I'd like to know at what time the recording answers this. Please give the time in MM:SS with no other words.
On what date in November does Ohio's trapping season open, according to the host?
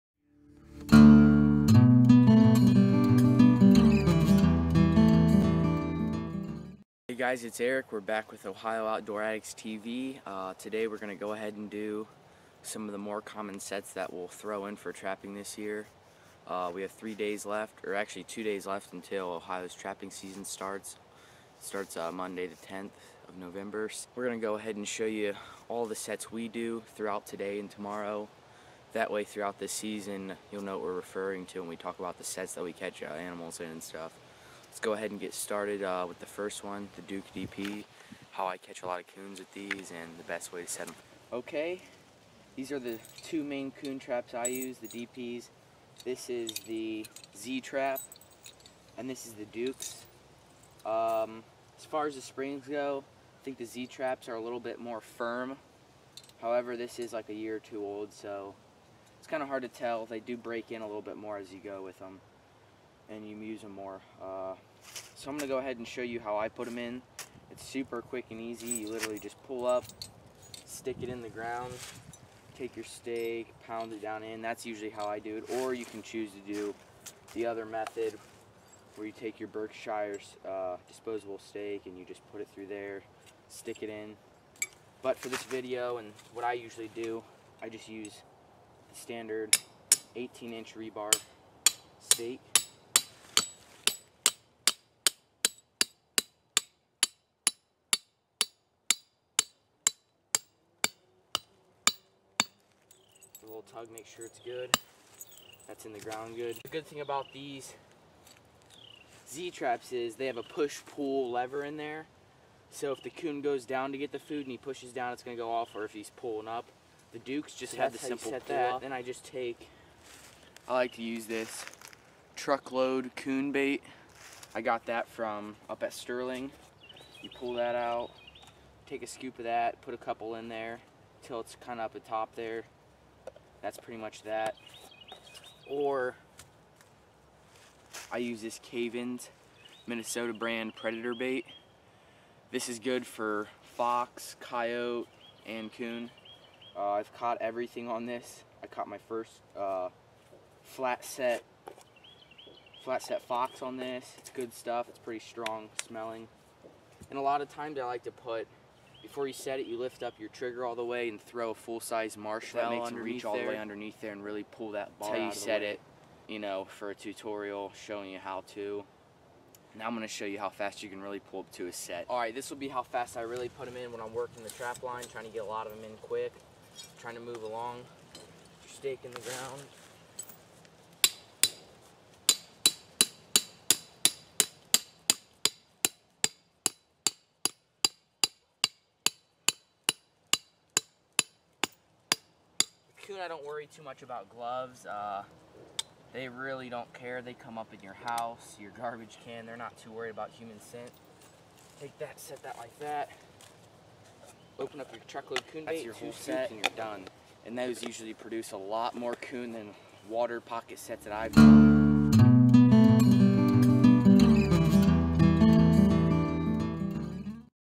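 00:22.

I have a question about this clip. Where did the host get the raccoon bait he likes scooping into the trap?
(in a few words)
Sterling.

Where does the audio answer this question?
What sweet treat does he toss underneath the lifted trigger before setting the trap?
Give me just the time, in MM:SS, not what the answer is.
02:41.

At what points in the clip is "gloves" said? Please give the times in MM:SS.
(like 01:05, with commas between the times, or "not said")
03:14.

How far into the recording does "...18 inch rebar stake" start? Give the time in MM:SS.
01:30.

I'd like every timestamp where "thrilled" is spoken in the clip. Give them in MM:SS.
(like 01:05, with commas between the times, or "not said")
not said.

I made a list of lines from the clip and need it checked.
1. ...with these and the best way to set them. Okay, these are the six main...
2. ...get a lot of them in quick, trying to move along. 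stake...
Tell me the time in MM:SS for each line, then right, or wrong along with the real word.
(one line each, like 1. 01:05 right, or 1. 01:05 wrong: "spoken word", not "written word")
1. 00:39 wrong: "two", not "six"
2. 02:55 right.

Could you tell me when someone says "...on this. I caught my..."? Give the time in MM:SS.
02:27.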